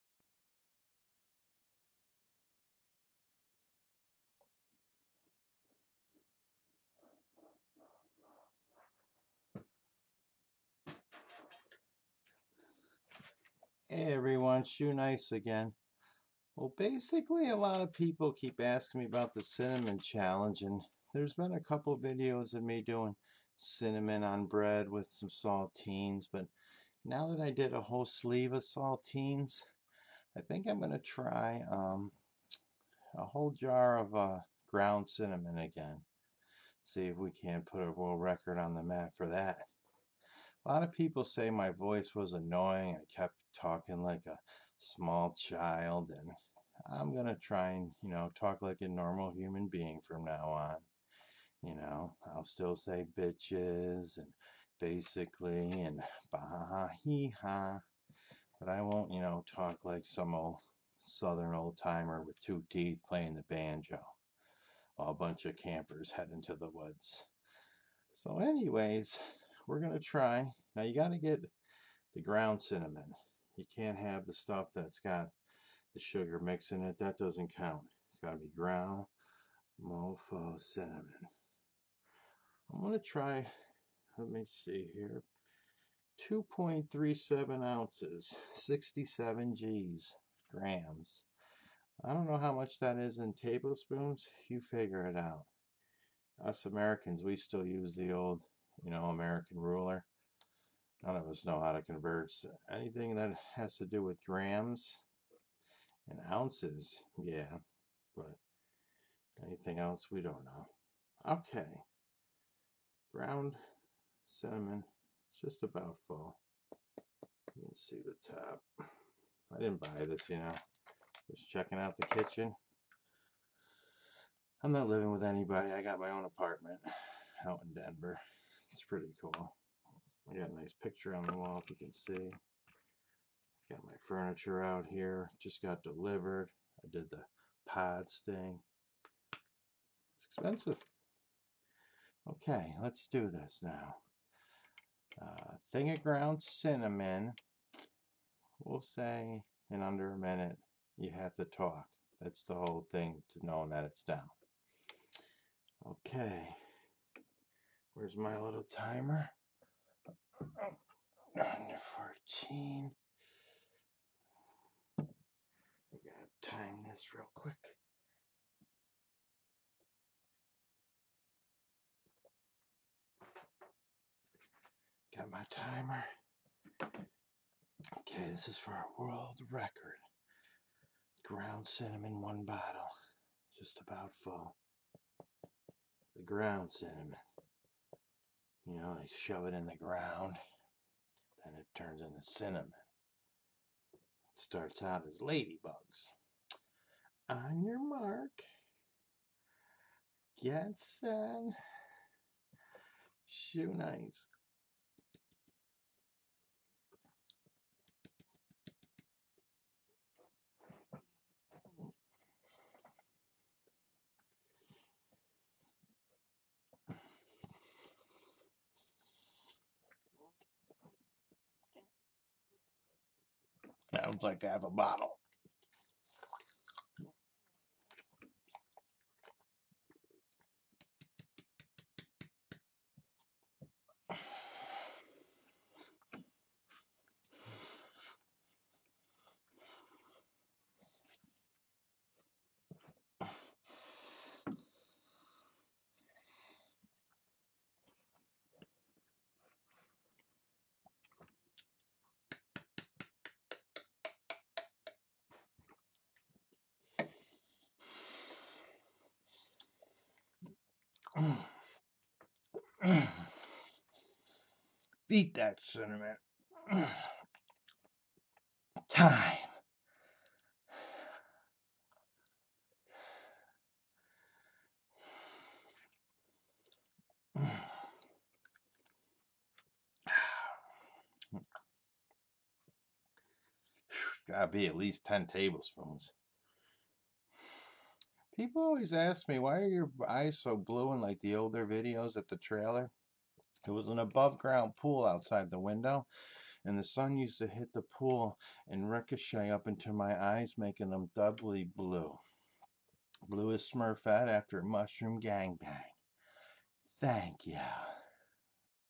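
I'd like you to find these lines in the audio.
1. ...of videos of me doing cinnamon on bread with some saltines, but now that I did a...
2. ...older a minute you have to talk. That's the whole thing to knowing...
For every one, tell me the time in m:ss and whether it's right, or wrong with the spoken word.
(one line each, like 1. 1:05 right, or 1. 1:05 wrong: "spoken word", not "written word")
1. 0:21 right
2. 2:29 wrong: "under", not "older".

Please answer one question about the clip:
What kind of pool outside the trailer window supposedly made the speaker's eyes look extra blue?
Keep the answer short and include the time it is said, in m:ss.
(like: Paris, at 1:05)
above ground pool, at 4:53.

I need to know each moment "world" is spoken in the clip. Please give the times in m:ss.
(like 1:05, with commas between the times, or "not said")
0:37, 2:59.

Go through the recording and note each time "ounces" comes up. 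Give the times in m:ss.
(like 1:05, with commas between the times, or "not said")
1:27, 1:46.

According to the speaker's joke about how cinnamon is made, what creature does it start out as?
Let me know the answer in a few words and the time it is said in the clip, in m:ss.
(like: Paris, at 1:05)
ladybugs, at 3:15.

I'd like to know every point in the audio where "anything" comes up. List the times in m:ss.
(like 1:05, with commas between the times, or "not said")
1:42, 1:49.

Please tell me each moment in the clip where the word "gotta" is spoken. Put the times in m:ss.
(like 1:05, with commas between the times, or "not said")
2:45, 4:44.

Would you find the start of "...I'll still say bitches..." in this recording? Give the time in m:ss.
0:52.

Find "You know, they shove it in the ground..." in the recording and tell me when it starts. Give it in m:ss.
3:08.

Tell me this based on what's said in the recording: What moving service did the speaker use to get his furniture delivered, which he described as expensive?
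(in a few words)
pods.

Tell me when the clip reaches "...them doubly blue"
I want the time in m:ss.
5:00.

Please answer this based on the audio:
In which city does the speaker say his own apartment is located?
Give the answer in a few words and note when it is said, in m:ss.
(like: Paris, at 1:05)
Denver, at 2:07.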